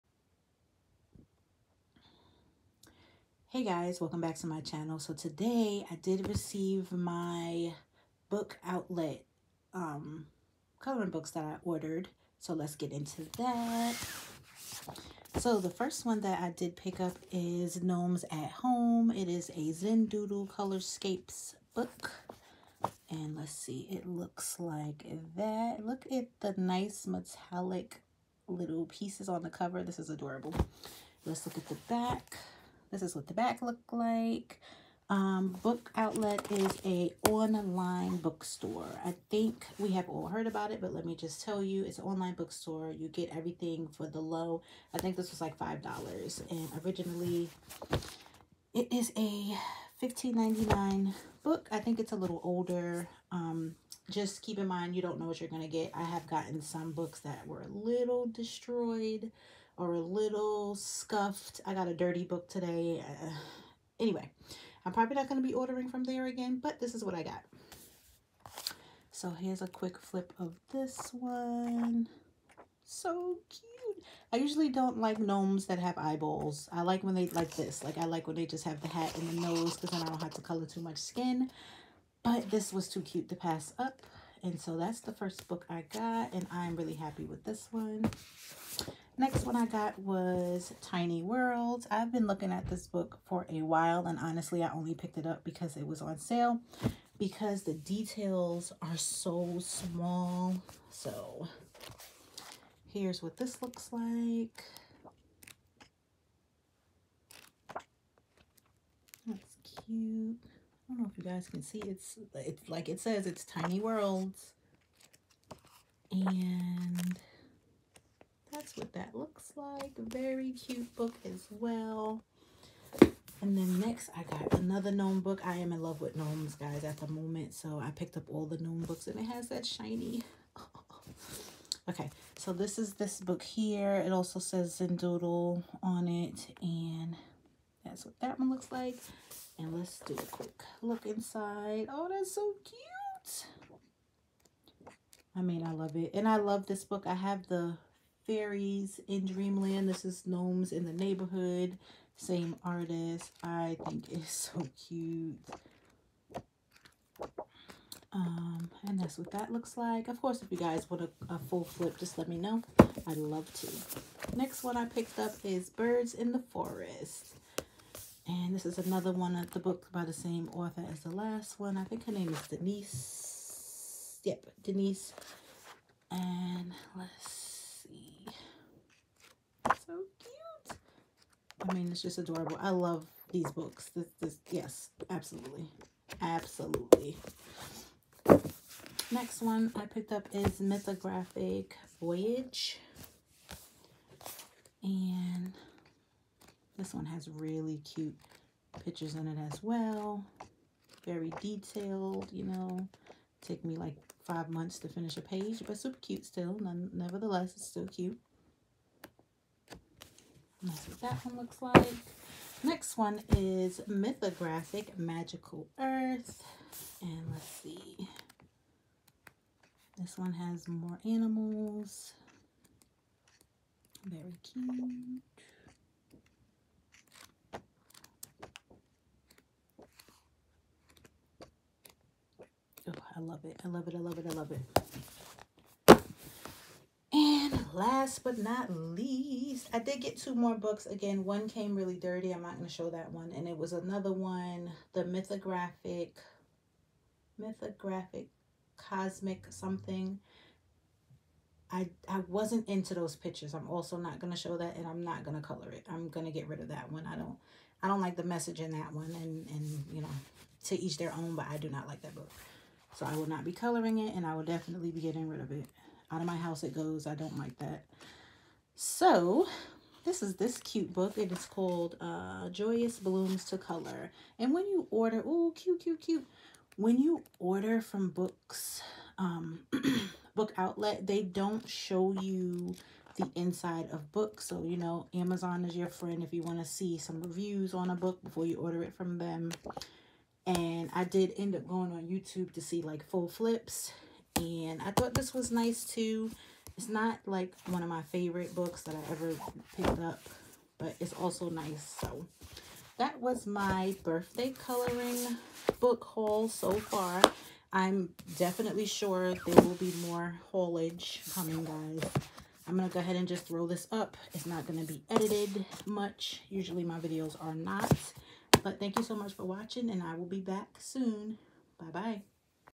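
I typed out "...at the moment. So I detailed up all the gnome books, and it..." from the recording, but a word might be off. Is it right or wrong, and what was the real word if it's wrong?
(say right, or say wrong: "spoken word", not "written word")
wrong: "picked", not "detailed".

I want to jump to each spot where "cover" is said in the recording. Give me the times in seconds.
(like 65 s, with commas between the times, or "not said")
29 s.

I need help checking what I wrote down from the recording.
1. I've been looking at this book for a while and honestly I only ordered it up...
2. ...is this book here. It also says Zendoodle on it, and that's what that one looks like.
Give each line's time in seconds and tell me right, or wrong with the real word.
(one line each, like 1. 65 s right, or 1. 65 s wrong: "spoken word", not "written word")
1. 91 s wrong: "picked", not "ordered"
2. 132 s right.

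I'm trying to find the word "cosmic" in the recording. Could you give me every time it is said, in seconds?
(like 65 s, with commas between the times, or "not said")
248 s.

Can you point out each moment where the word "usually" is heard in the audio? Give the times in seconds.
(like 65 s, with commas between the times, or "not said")
74 s, 316 s.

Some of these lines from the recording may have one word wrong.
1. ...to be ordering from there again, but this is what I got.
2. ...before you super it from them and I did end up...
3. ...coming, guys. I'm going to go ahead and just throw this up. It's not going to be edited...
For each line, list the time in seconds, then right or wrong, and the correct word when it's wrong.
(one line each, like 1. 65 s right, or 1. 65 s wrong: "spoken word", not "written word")
1. 65 s right
2. 288 s wrong: "order", not "super"
3. 311 s right.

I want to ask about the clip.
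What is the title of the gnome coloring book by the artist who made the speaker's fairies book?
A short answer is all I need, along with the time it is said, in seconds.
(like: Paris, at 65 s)
Gnomes in the Neighborhood, at 150 s.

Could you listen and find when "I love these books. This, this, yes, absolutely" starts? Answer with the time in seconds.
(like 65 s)
182 s.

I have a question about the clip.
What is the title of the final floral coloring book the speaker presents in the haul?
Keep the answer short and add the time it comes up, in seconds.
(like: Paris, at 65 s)
Joyous Blooms to Color, at 272 s.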